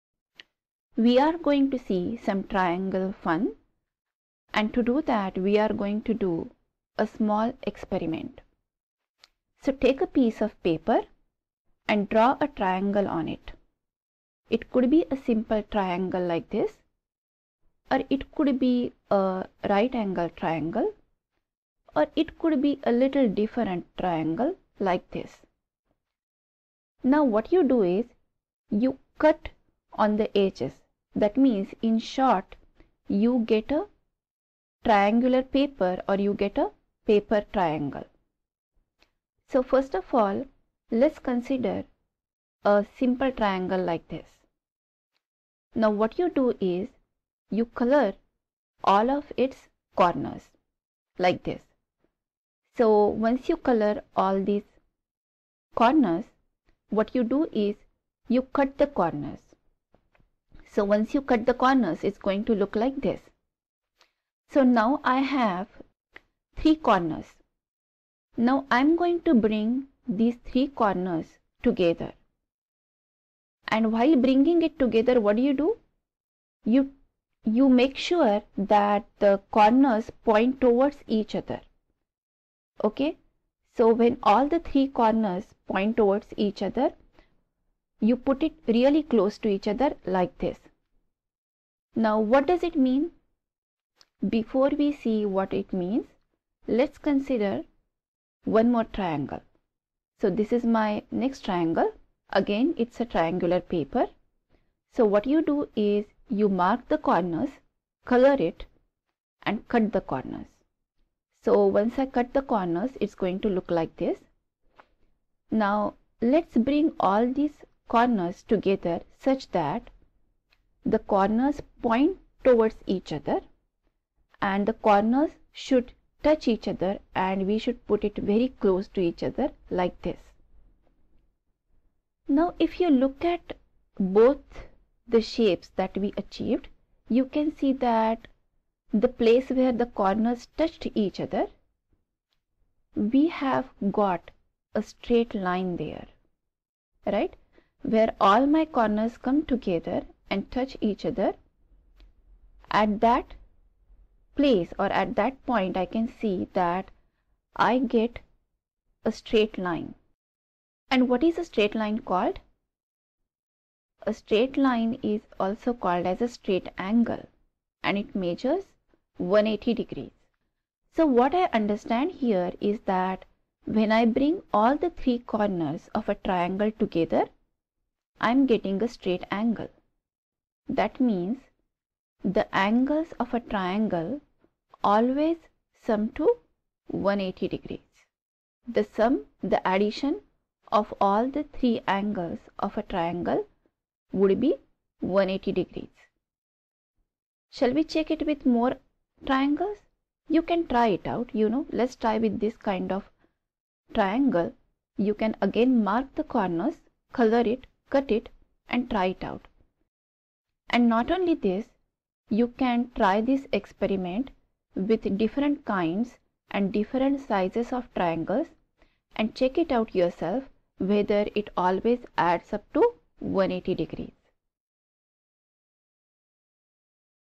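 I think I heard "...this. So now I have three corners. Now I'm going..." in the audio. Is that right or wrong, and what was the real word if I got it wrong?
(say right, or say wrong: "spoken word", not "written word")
right.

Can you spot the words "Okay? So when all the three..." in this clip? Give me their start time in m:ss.
1:22.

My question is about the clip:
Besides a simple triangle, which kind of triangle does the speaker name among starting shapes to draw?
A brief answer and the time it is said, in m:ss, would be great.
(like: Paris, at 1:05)
right angle triangle, at 0:19.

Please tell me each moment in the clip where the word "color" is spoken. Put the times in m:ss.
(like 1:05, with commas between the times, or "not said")
0:47, 0:53, 1:48, 3:27.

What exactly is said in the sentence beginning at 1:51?
So once I cut the corners, it's going to look like this.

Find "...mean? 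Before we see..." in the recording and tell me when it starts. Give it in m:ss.
1:32.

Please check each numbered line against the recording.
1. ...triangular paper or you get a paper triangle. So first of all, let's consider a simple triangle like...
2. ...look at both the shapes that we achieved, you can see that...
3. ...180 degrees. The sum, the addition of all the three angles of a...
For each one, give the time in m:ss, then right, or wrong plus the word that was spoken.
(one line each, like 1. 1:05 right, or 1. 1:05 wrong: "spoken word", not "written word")
1. 0:34 right
2. 2:12 right
3. 3:06 right.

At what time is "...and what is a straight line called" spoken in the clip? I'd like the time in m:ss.
2:40.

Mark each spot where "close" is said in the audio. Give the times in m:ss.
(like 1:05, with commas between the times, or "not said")
1:29, 2:08.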